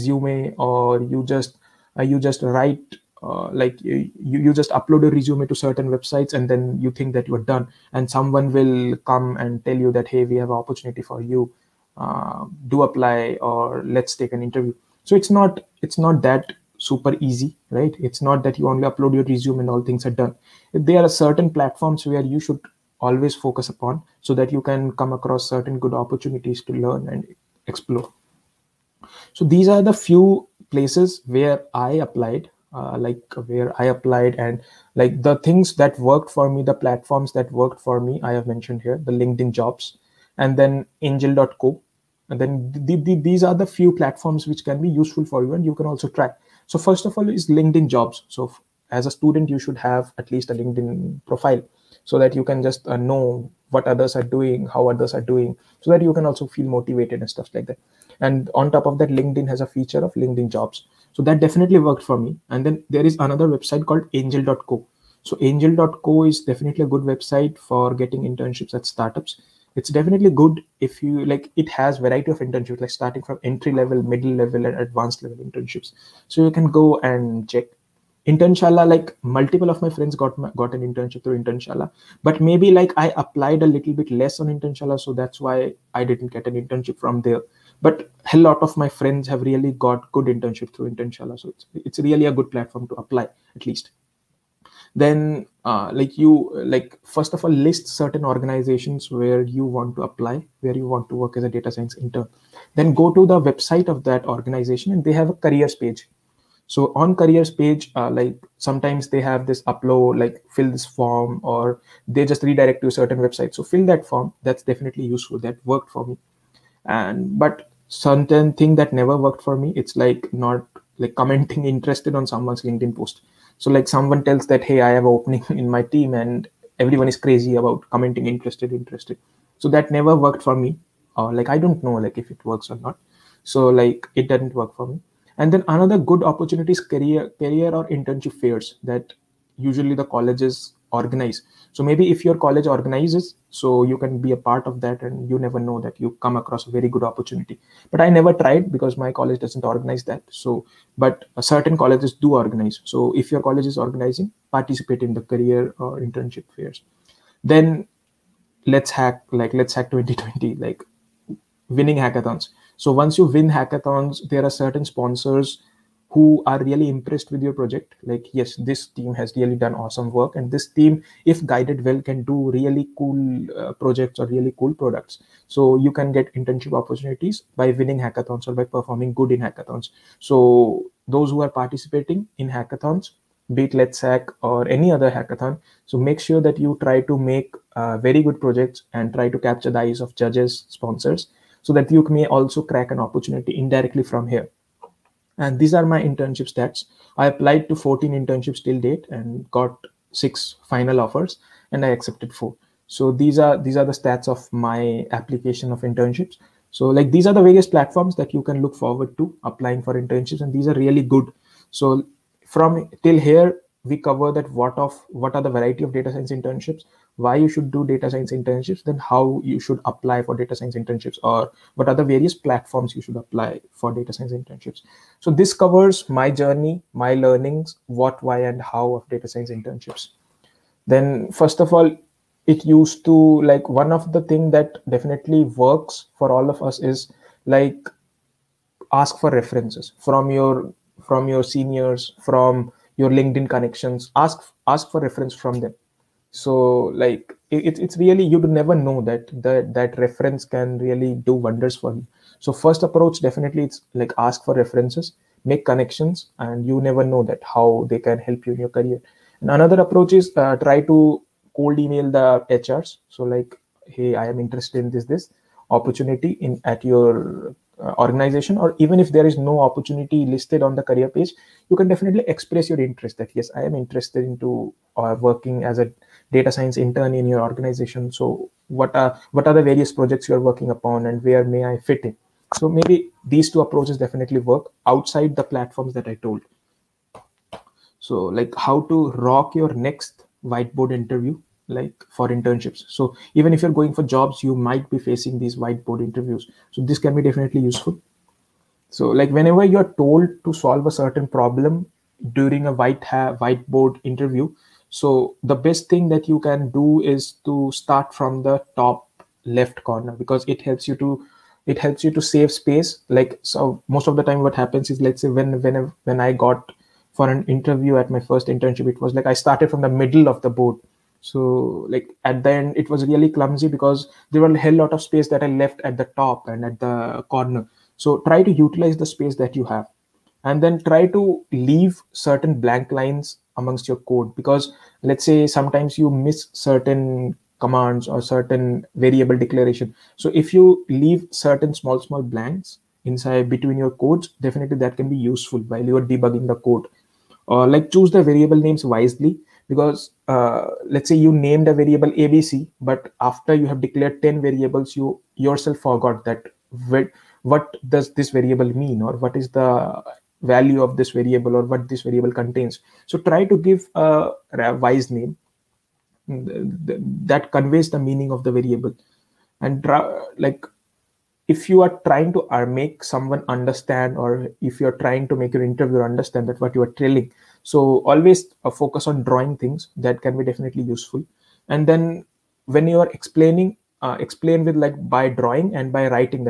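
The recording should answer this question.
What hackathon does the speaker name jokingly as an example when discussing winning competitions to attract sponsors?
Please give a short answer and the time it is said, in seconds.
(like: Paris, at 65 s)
Let's Hack 2020, at 159 s.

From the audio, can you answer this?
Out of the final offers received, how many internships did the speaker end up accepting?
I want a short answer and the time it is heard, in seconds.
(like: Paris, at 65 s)
4, at 202 s.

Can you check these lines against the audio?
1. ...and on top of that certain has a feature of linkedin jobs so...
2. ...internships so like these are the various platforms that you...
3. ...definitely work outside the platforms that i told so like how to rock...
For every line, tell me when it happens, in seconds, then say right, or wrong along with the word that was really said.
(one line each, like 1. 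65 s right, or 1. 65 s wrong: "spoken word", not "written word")
1. 58 s wrong: "linkedin", not "certain"
2. 205 s right
3. 283 s right.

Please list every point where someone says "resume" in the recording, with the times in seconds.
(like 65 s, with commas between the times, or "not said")
5 s, 19 s.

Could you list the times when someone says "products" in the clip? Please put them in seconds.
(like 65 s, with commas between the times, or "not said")
174 s.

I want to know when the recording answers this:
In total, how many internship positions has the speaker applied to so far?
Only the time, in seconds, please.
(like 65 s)
197 s.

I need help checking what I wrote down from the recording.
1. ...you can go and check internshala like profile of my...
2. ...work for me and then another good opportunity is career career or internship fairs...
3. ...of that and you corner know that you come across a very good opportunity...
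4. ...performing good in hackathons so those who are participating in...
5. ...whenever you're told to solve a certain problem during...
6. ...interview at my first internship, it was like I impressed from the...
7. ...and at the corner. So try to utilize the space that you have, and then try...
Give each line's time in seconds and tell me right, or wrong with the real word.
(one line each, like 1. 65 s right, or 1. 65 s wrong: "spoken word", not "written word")
1. 76 s wrong: "multiple", not "profile"
2. 134 s right
3. 144 s wrong: "never", not "corner"
4. 178 s right
5. 299 s right
6. 317 s wrong: "started", not "impressed"
7. 326 s right.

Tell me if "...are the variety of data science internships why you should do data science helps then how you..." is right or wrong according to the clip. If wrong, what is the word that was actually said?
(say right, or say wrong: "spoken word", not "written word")
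wrong: "internships", not "helps".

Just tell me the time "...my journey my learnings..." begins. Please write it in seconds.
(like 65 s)
226 s.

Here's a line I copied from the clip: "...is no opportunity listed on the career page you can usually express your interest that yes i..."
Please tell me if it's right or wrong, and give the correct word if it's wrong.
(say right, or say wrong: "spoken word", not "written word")
wrong: "definitely", not "usually".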